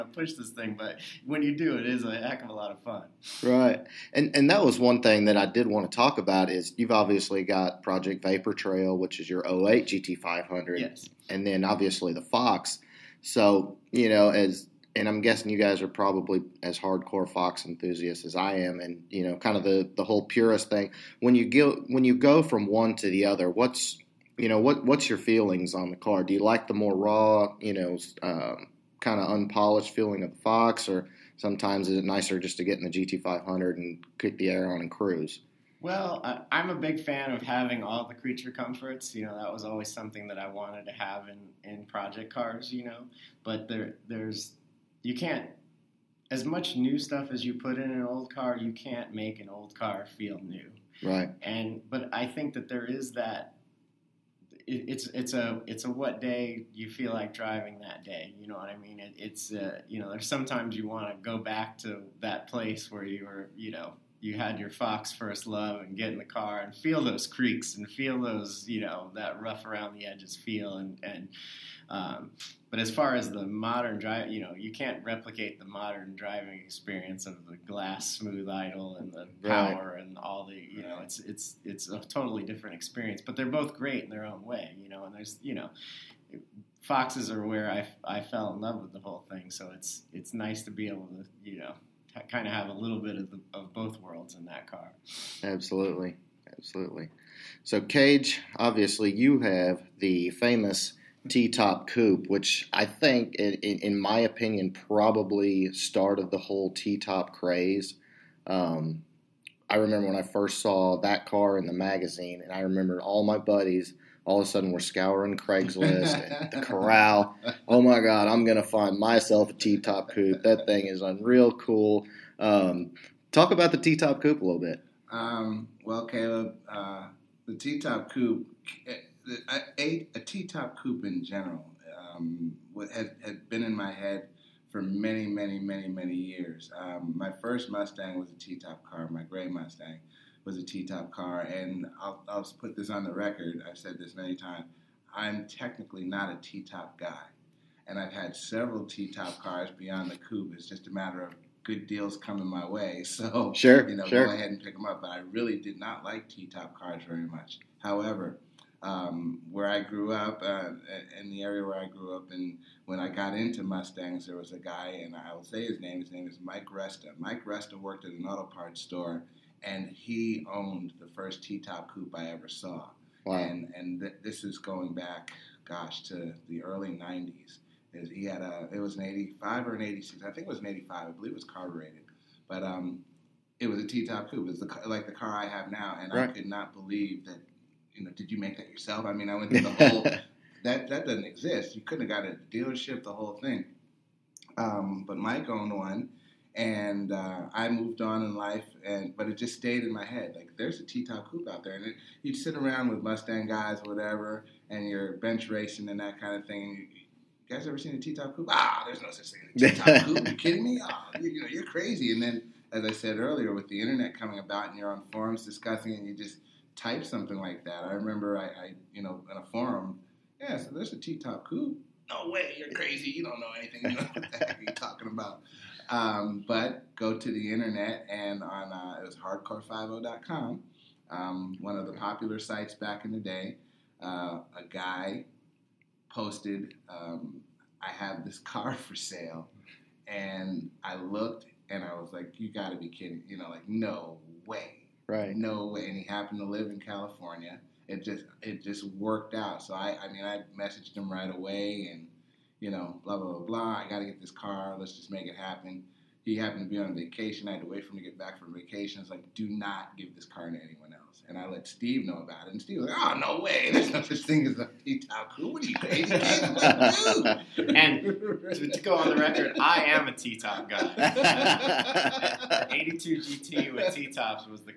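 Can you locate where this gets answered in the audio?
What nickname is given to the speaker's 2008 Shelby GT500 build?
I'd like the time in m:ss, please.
0:07.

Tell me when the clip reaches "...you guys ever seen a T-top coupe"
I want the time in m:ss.
3:27.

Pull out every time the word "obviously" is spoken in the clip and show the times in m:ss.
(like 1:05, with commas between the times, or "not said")
0:06, 0:11, 1:38.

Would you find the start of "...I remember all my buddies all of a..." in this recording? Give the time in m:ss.
1:52.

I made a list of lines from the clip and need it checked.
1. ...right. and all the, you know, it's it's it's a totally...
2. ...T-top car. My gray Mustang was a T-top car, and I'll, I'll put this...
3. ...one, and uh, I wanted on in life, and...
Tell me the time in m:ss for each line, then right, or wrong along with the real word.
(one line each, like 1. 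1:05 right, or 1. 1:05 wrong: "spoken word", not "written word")
1. 1:19 right
2. 2:18 right
3. 3:15 wrong: "moved", not "wanted".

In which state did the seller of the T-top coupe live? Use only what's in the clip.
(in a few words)
California.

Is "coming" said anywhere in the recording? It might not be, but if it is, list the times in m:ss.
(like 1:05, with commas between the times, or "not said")
2:32, 3:34.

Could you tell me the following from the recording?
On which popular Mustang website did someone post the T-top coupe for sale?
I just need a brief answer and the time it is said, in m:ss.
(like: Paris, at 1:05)
hardcore50.com, at 3:49.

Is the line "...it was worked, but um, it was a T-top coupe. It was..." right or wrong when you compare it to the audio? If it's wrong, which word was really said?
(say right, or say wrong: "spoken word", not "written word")
wrong: "carbureted", not "worked".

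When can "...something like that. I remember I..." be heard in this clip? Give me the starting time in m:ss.
3:37.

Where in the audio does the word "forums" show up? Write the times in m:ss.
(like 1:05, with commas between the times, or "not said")
3:35, 3:39.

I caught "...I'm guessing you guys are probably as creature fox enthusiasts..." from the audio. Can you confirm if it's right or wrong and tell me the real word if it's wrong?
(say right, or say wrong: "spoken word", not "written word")
wrong: "hardcore", not "creature".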